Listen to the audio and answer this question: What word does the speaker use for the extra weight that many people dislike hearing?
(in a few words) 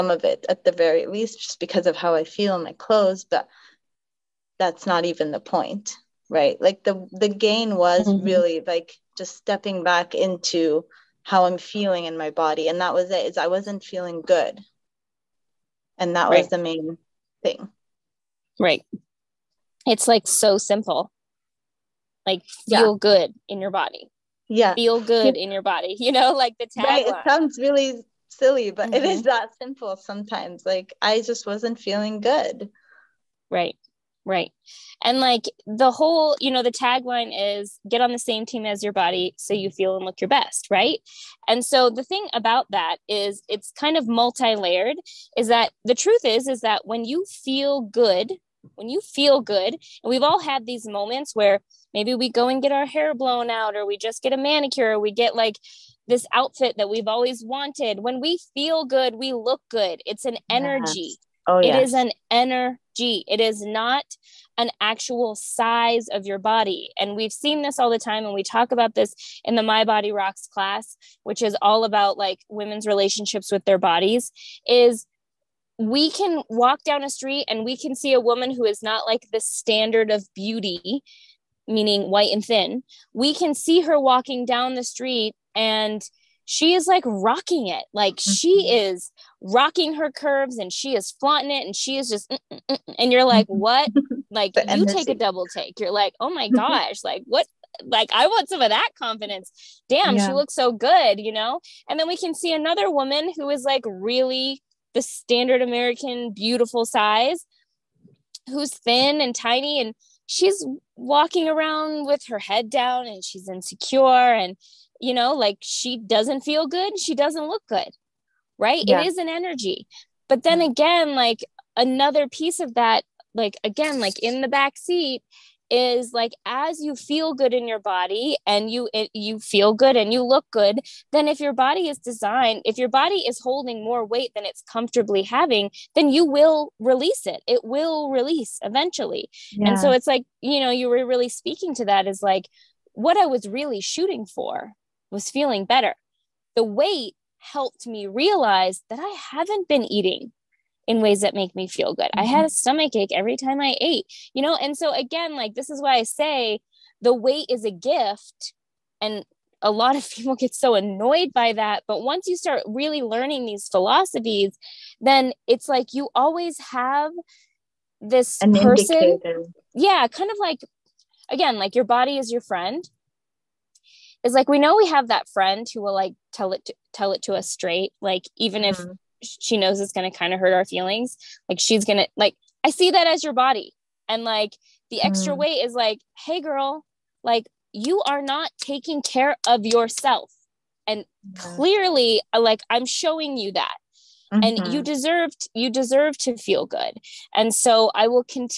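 gift.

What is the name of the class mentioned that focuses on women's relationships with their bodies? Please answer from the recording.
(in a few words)
My Body Rocks.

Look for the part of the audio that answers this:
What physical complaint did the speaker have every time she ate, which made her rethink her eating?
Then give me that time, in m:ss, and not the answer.
2:32.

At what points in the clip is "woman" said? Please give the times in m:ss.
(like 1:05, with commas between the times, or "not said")
1:18, 1:42.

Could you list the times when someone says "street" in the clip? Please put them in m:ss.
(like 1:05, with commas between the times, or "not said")
1:17, 1:24.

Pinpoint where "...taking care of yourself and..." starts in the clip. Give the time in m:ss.
3:08.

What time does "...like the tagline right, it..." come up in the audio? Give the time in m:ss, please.
0:26.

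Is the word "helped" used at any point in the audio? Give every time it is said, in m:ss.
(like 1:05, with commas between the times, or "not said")
2:27.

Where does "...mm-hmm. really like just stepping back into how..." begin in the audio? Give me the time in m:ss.
0:08.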